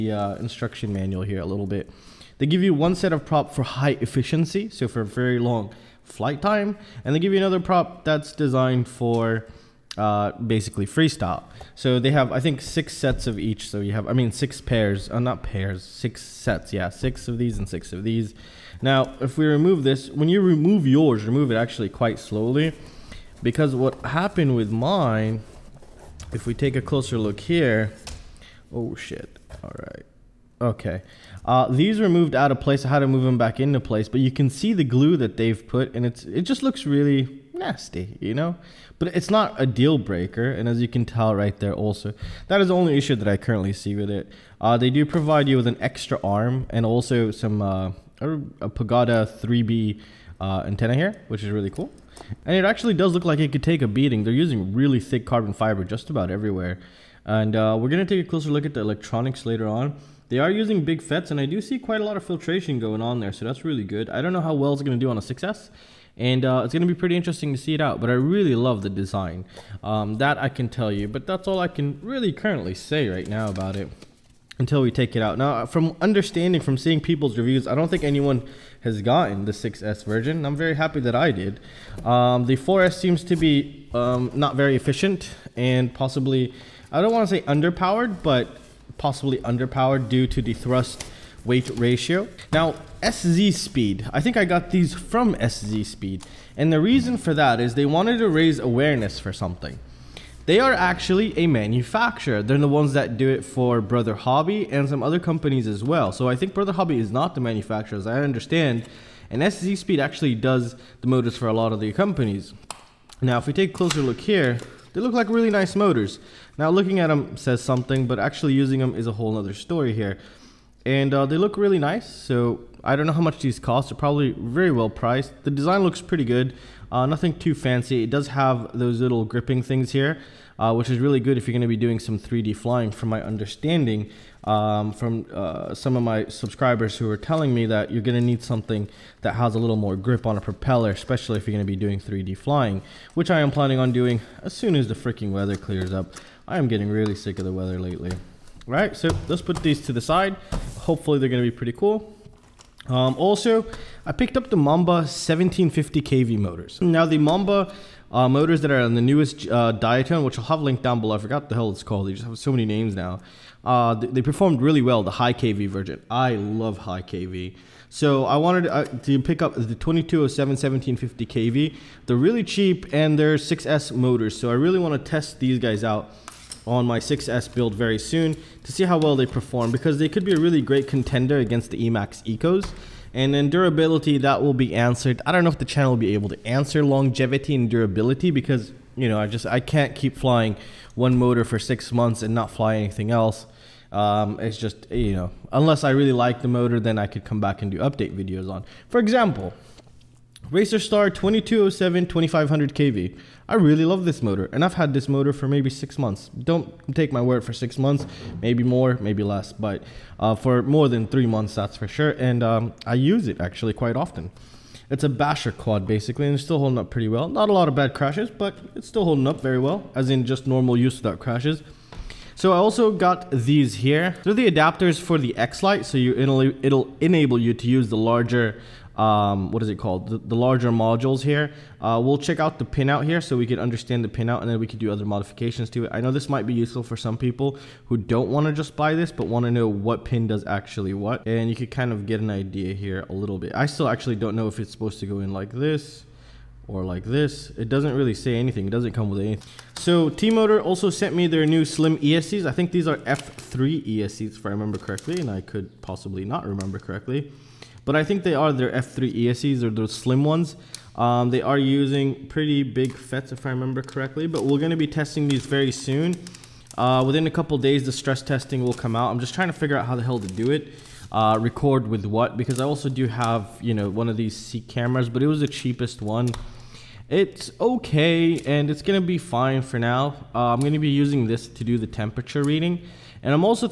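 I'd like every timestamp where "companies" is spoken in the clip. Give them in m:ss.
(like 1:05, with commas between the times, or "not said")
1:45, 1:51.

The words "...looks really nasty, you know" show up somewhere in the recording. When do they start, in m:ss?
0:36.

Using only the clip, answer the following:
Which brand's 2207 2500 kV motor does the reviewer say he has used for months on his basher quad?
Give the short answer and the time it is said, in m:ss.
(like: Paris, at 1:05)
Racerstar, at 3:20.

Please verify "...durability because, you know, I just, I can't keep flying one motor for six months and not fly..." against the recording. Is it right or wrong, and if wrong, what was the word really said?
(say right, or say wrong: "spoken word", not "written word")
right.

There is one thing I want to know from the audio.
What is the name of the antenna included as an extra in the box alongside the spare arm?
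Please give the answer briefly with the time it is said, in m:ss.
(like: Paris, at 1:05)
Pagoda 3B, at 0:48.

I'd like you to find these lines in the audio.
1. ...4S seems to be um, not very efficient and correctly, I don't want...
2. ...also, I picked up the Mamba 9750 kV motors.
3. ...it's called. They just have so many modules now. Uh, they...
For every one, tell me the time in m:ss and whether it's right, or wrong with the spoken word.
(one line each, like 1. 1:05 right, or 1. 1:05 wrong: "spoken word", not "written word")
1. 1:22 wrong: "possibly", not "correctly"
2. 2:33 wrong: "1750", not "9750"
3. 2:41 wrong: "names", not "modules".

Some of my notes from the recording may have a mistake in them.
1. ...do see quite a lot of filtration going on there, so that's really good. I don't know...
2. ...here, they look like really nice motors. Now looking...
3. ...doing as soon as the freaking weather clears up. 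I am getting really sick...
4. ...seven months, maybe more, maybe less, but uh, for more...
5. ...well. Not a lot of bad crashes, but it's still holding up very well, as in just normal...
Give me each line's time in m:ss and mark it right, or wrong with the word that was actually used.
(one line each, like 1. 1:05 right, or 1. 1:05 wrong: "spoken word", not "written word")
1. 1:01 right
2. 1:54 right
3. 2:23 right
4. 3:27 wrong: "six", not "seven"
5. 3:37 right.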